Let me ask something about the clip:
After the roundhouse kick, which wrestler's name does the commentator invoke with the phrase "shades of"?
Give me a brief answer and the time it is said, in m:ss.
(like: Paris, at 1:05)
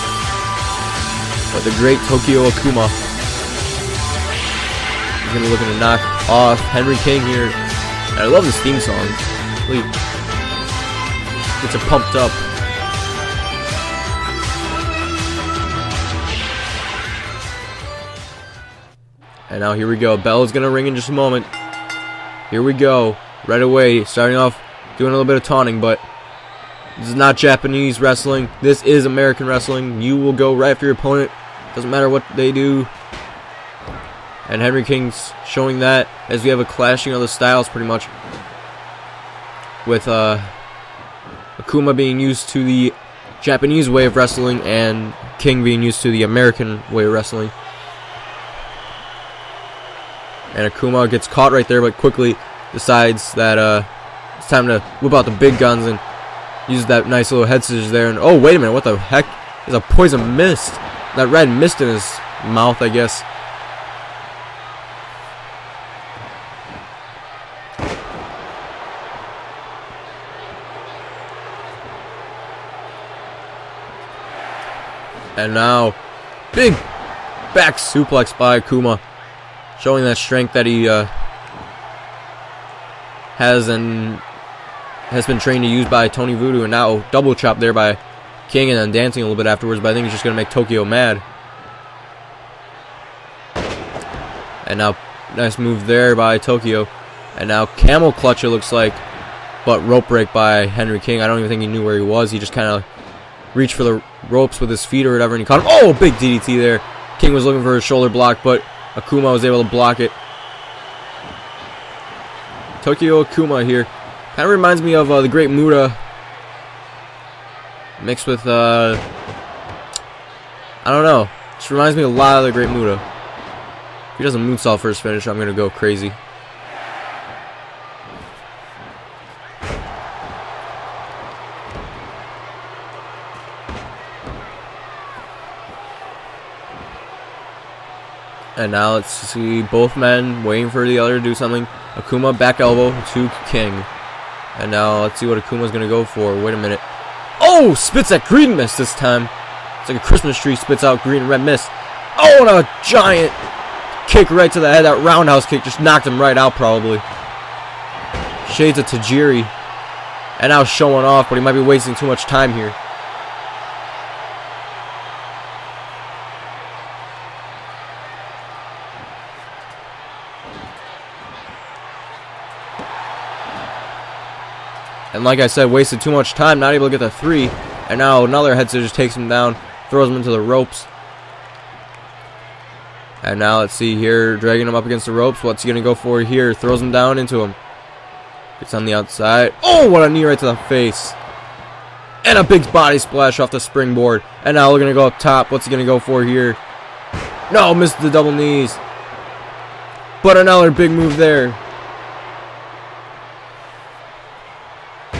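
Tajiri, at 2:38.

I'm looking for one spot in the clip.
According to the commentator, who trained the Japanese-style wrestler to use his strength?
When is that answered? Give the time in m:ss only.
1:26.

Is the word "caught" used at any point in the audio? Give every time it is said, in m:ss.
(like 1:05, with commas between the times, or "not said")
0:51, 1:45.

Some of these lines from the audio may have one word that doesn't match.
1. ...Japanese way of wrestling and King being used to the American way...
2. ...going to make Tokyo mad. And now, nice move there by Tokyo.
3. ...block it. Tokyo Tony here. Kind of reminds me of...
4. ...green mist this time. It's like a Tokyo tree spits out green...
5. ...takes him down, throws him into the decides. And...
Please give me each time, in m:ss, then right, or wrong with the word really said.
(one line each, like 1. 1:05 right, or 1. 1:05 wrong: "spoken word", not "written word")
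1. 0:43 right
2. 1:30 right
3. 1:49 wrong: "Akuma", not "Tony"
4. 2:28 wrong: "Christmas", not "Tokyo"
5. 2:58 wrong: "ropes", not "decides".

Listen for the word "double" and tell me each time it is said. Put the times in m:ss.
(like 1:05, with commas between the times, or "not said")
1:27, 3:18.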